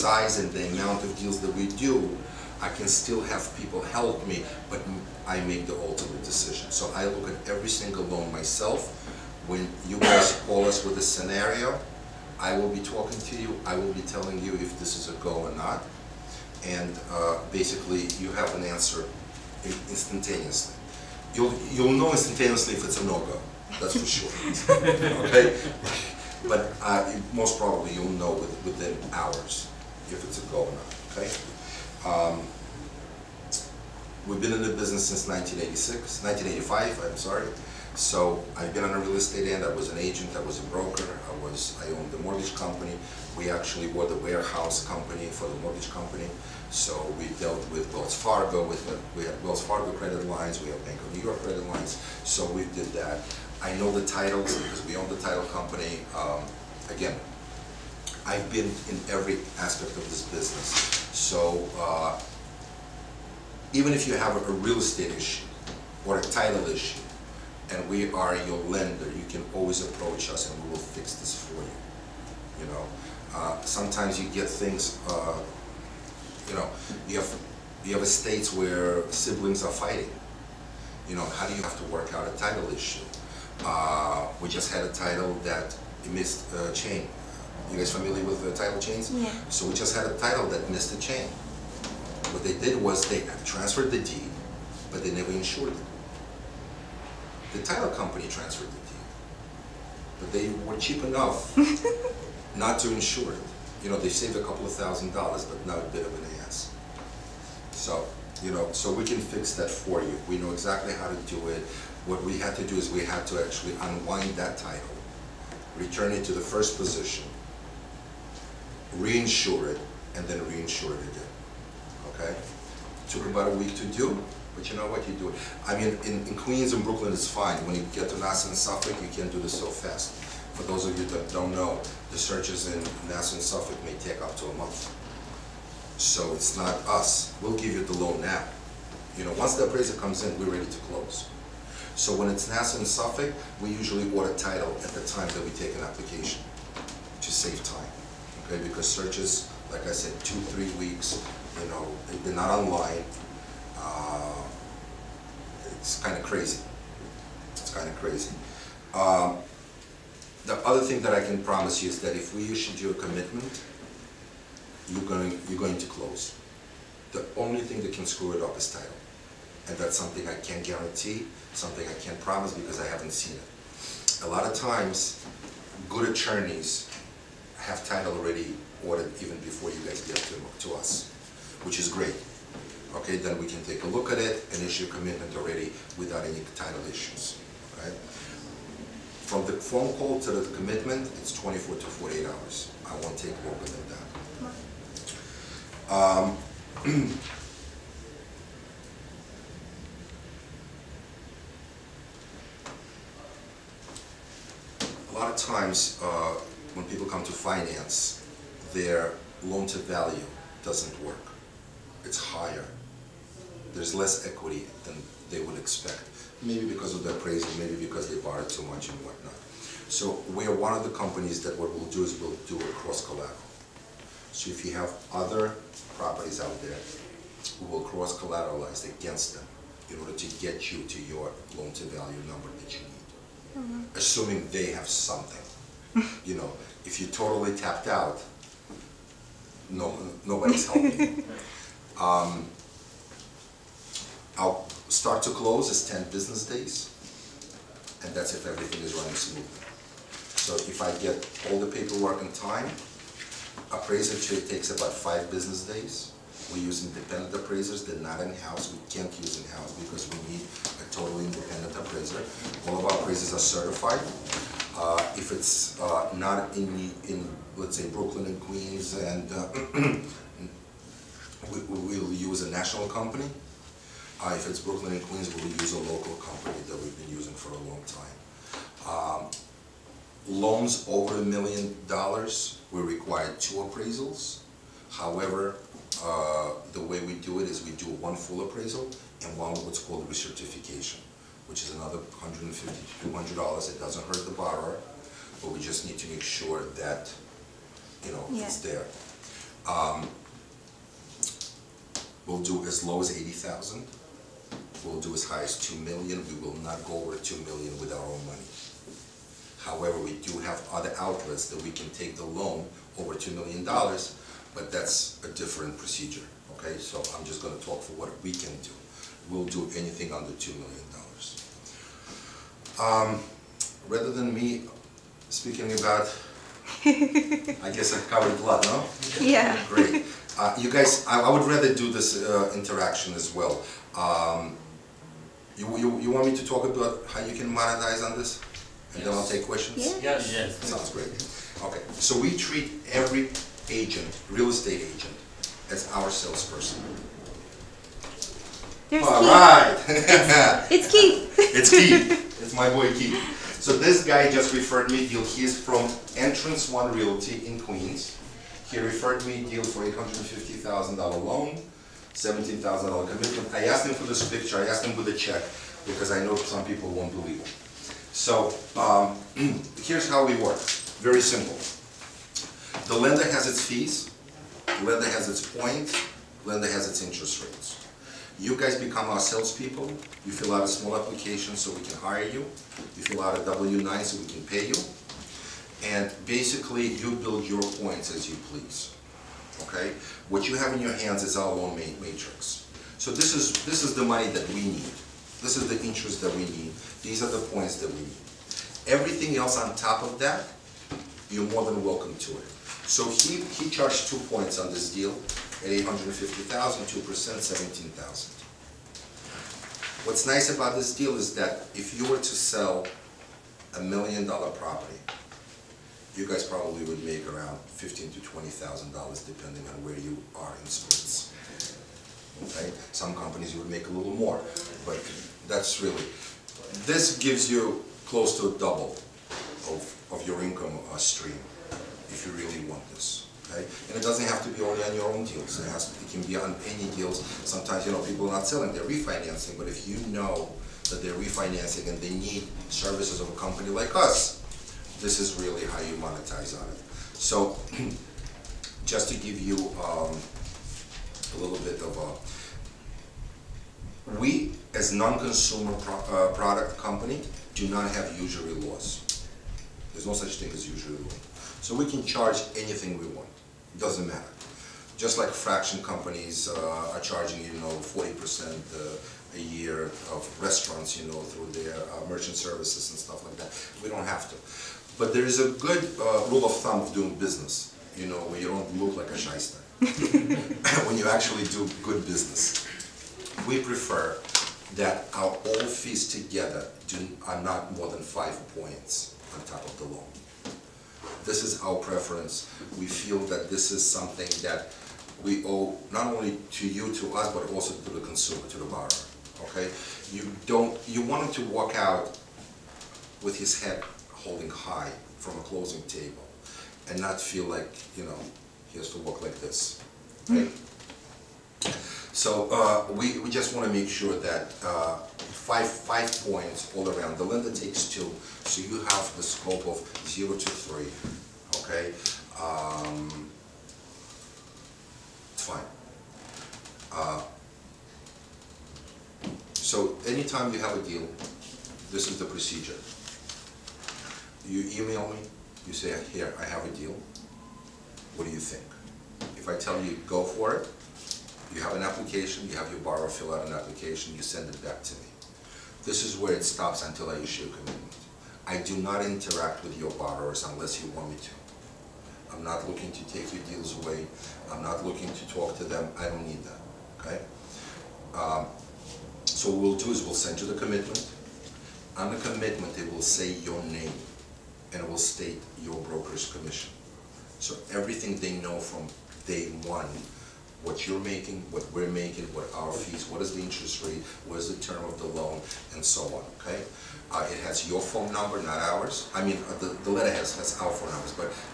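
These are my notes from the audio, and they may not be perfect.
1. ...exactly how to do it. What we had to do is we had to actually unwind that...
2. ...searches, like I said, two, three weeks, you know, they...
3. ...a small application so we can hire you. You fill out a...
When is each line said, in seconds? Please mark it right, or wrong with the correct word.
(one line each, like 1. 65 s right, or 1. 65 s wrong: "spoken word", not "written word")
1. 110 s right
2. 148 s right
3. 380 s right.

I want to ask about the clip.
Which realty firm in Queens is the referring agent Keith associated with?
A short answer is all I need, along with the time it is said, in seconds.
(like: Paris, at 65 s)
Entrance One Realty, at 356 s.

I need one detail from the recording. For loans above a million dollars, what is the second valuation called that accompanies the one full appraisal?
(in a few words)
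recertification.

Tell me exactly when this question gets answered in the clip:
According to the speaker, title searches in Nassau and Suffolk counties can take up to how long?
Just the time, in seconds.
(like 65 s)
134 s.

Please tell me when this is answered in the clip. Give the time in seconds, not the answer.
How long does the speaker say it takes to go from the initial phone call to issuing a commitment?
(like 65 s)
191 s.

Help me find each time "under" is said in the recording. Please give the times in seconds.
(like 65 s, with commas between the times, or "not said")
320 s.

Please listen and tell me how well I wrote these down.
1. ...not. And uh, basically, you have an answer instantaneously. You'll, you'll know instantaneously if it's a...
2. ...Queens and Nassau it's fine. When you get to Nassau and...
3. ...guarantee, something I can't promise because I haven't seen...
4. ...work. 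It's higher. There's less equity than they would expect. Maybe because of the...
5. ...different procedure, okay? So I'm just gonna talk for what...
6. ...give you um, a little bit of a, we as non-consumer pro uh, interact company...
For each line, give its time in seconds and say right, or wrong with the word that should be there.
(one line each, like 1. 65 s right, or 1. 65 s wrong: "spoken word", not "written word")
1. 15 s right
2. 126 s wrong: "Brooklyn", not "Nassau"
3. 170 s right
4. 211 s right
5. 315 s right
6. 449 s wrong: "product", not "interact".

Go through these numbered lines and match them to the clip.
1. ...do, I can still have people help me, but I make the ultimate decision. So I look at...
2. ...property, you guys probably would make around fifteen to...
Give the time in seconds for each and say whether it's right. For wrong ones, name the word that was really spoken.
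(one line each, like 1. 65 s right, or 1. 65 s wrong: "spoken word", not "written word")
1. 1 s right
2. 414 s right.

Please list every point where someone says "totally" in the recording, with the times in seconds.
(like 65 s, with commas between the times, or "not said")
237 s, 260 s.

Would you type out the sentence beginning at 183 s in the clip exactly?
Okay, then we can take a look at it and issue a commitment already without any title issues.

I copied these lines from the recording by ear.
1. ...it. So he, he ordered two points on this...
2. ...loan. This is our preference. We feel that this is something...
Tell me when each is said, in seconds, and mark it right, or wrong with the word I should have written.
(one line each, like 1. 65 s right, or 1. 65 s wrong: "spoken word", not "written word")
1. 402 s wrong: "charged", not "ordered"
2. 489 s right.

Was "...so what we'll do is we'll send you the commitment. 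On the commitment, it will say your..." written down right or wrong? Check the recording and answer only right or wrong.
right.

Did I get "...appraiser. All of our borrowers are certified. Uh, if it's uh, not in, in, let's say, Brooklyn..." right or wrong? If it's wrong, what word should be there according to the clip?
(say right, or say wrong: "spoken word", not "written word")
wrong: "appraisers", not "borrowers".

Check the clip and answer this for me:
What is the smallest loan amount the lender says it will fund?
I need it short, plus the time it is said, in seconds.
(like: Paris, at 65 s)
80,000, at 303 s.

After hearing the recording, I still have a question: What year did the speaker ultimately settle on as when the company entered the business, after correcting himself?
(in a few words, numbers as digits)
1985.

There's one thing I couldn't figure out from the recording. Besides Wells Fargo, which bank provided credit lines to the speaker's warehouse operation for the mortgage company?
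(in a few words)
Bank of New York.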